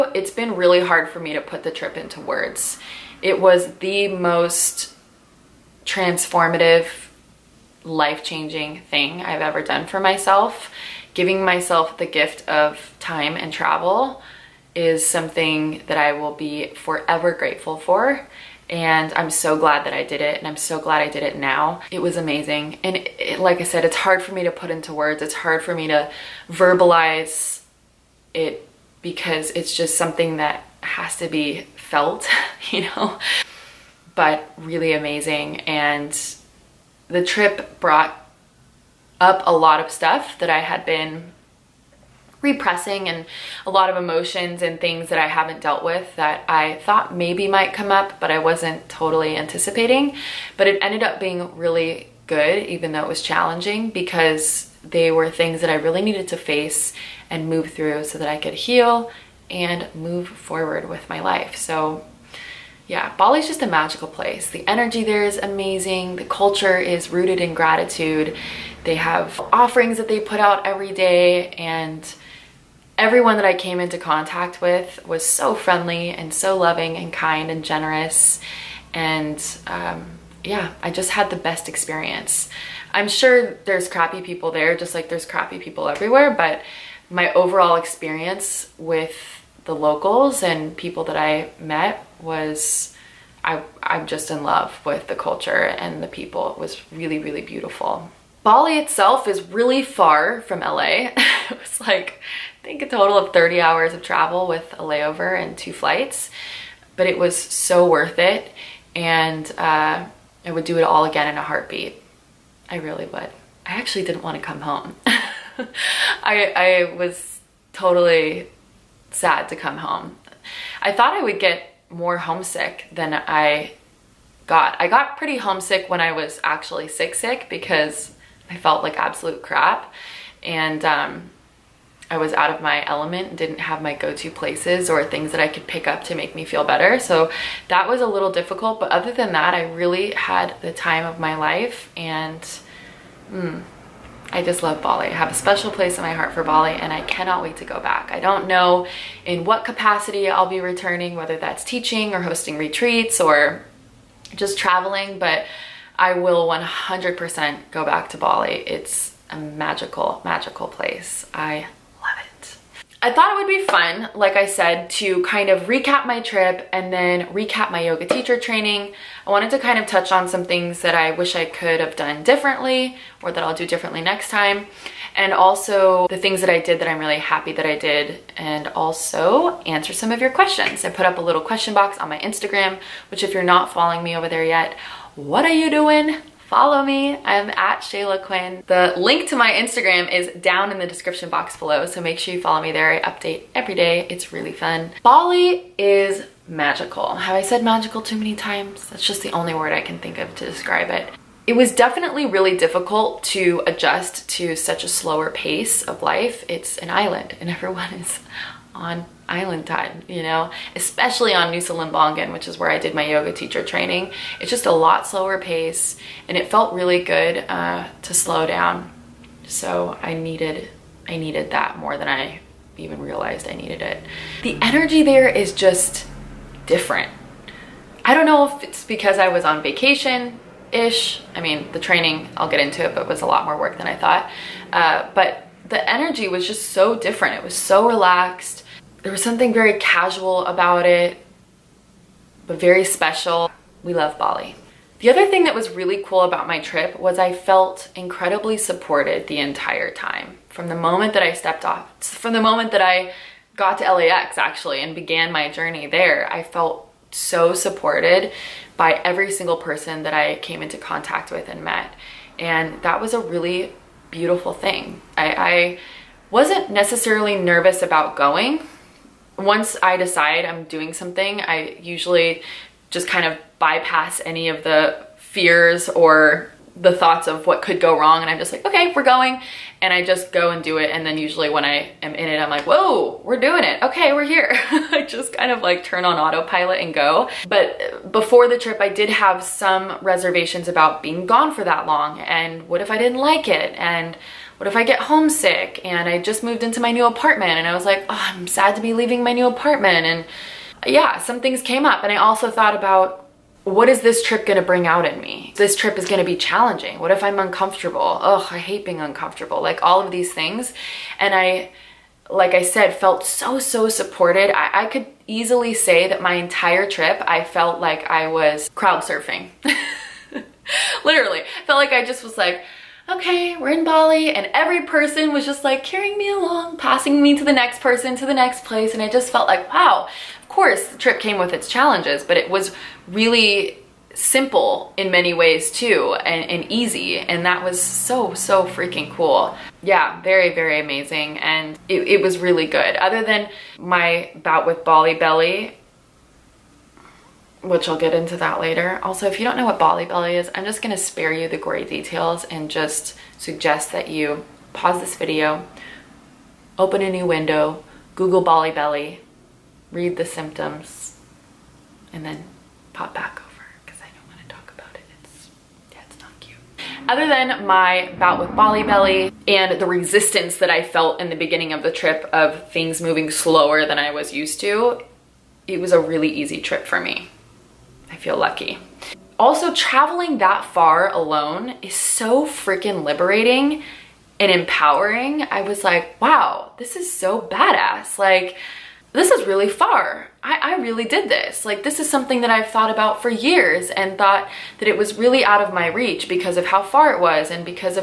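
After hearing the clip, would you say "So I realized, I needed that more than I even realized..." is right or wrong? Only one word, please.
wrong.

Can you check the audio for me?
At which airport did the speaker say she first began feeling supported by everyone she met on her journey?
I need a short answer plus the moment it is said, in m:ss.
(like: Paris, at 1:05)
LAX, at 4:13.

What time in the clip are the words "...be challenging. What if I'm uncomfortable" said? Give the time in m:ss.
5:06.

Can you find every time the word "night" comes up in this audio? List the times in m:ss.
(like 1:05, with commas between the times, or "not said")
not said.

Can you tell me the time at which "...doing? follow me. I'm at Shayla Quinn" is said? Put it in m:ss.
3:05.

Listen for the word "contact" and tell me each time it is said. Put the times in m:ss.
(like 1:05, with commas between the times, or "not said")
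1:13, 4:20.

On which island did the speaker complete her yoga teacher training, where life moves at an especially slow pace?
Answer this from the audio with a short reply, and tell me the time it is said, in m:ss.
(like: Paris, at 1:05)
Nusa Lembongan, at 3:31.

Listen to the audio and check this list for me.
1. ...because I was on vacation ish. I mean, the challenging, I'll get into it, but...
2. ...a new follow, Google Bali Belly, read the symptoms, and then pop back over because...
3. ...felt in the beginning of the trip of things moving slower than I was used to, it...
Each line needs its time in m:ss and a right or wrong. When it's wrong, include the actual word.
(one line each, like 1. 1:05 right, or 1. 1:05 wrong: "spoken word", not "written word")
1. 3:48 wrong: "training", not "challenging"
2. 5:57 wrong: "window", not "follow"
3. 6:10 right.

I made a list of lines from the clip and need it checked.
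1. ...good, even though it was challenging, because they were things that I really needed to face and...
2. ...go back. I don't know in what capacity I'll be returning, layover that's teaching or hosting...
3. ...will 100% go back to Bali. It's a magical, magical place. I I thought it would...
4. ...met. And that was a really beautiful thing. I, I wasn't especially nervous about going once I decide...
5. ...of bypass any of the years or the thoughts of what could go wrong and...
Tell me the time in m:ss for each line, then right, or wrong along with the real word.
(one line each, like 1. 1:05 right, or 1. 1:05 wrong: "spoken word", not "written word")
1. 0:52 right
2. 2:27 wrong: "whether", not "layover"
3. 2:36 right
4. 4:21 wrong: "necessarily", not "especially"
5. 4:33 wrong: "fears", not "years".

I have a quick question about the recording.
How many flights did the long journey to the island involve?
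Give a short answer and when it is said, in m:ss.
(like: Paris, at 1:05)
2, at 1:45.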